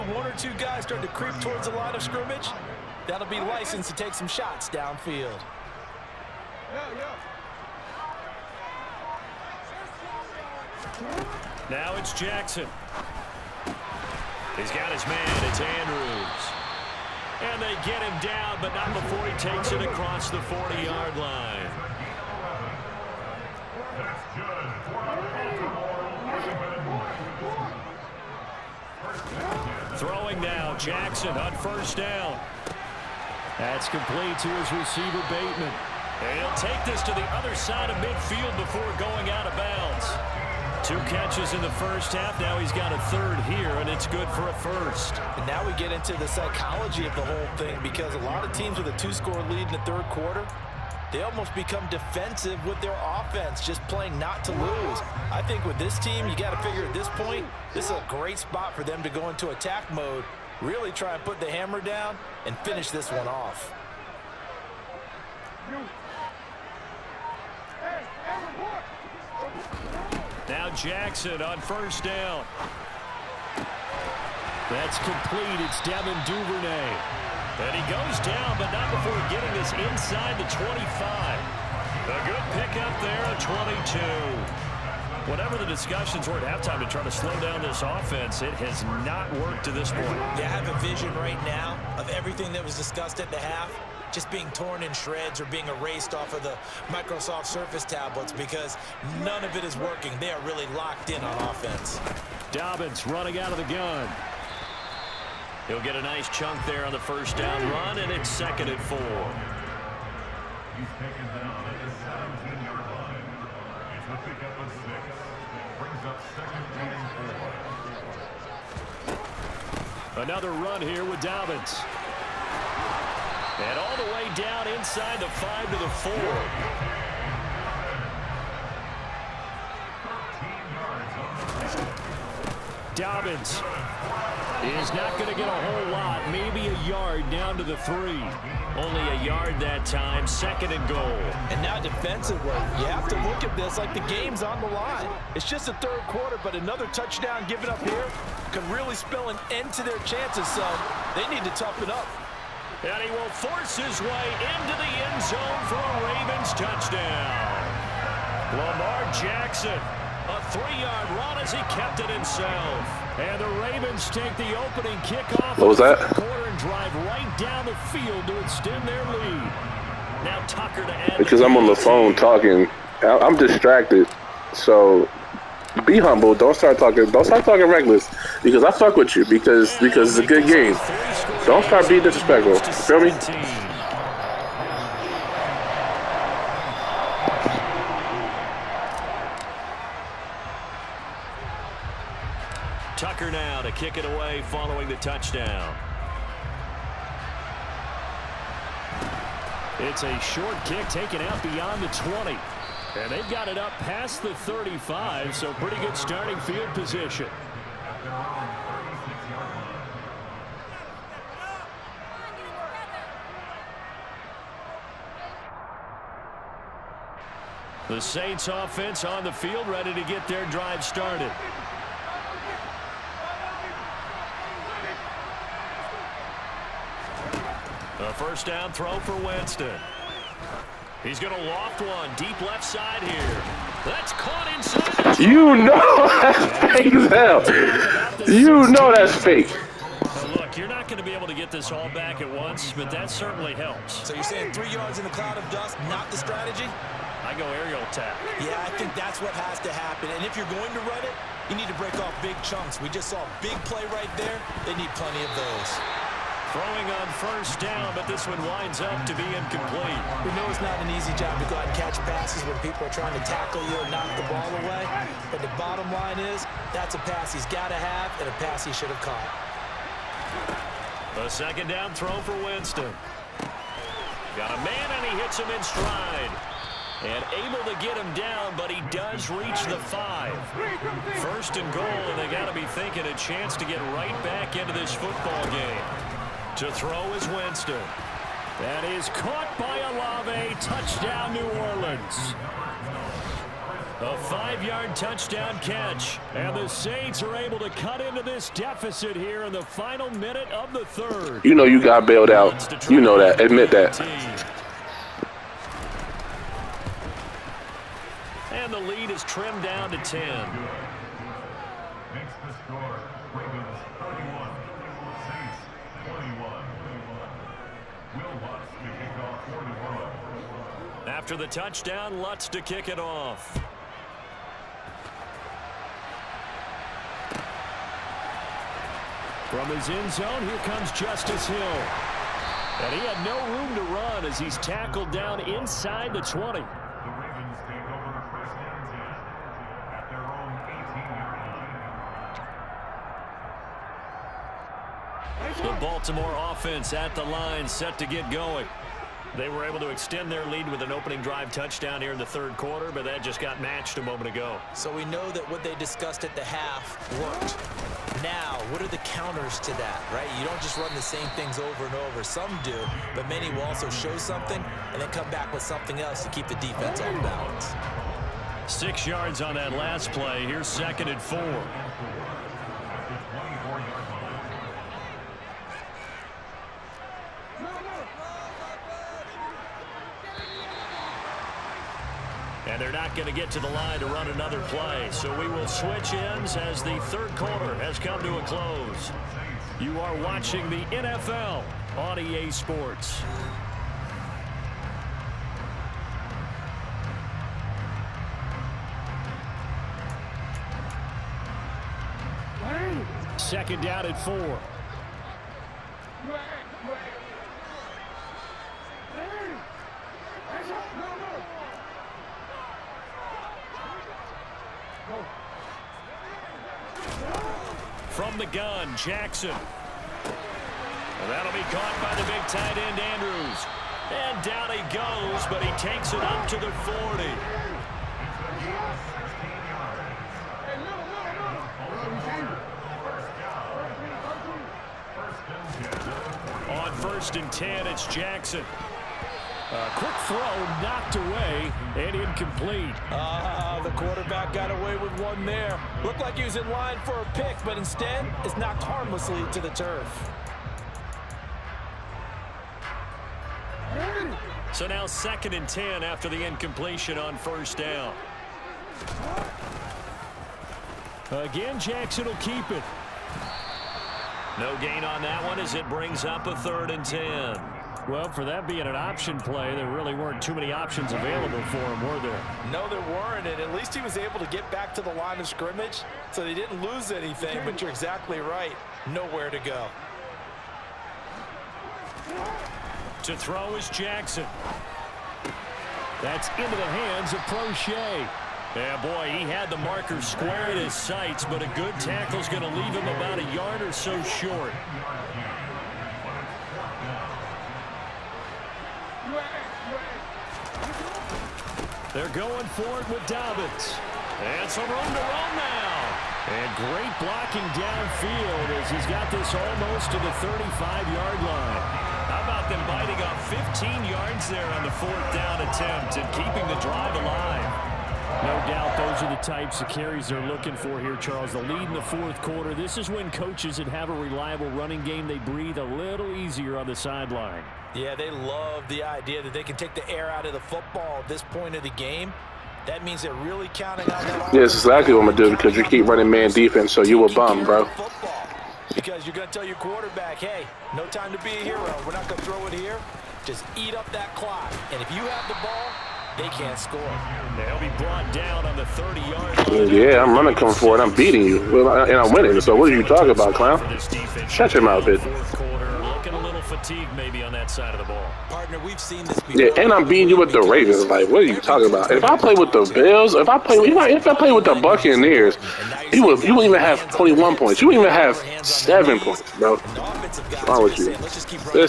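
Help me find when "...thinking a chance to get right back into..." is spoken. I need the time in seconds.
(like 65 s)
282 s.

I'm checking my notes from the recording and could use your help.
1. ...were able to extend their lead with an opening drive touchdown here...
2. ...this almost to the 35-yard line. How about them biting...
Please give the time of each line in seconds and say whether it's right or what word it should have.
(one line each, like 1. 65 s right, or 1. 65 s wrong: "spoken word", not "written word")
1. 349 s right
2. 509 s right.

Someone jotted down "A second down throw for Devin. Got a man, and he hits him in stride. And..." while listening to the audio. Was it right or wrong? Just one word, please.
wrong.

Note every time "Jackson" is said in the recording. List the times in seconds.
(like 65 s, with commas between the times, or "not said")
12 s, 30 s, 70 s, 159 s, 419 s, 438 s, 461 s, 483 s.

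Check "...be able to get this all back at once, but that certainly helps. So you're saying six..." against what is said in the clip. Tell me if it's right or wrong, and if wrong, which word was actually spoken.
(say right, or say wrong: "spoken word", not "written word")
wrong: "three", not "six".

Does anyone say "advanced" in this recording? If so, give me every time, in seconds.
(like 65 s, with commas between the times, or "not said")
not said.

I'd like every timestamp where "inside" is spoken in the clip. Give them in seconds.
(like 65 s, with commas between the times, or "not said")
79 s, 124 s, 234 s, 335 s.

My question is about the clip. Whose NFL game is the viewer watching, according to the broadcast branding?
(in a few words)
EA Sports.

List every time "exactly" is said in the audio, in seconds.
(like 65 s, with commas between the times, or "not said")
477 s, 534 s.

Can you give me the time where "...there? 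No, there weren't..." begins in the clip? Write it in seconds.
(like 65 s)
472 s.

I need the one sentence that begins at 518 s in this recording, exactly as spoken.
No doubt those are the types of carries they're looking for here, Charles.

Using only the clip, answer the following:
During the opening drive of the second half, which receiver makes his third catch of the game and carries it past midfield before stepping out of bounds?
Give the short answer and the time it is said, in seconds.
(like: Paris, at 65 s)
Bateman, at 35 s.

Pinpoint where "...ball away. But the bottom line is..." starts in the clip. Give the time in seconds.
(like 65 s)
264 s.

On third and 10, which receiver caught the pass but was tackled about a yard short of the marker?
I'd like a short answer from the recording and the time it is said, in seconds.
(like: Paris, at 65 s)
Proche, at 487 s.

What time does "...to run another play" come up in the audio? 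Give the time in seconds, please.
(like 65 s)
383 s.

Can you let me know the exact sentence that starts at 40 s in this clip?
Two catches in the first half.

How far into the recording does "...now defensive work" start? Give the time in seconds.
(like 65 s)
141 s.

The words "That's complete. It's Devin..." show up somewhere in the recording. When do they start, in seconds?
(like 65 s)
74 s.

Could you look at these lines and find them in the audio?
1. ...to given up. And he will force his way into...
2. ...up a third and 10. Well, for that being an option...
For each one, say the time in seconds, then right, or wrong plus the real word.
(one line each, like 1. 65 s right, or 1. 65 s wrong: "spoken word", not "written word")
1. 151 s wrong: "toughen", not "given"
2. 466 s right.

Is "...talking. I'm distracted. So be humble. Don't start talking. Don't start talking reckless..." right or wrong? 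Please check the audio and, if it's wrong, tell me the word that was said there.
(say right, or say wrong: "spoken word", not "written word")
right.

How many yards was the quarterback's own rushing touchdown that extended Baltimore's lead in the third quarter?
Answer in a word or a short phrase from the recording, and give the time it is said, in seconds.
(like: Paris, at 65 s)
3, at 160 s.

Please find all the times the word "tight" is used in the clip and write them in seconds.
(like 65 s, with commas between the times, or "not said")
422 s.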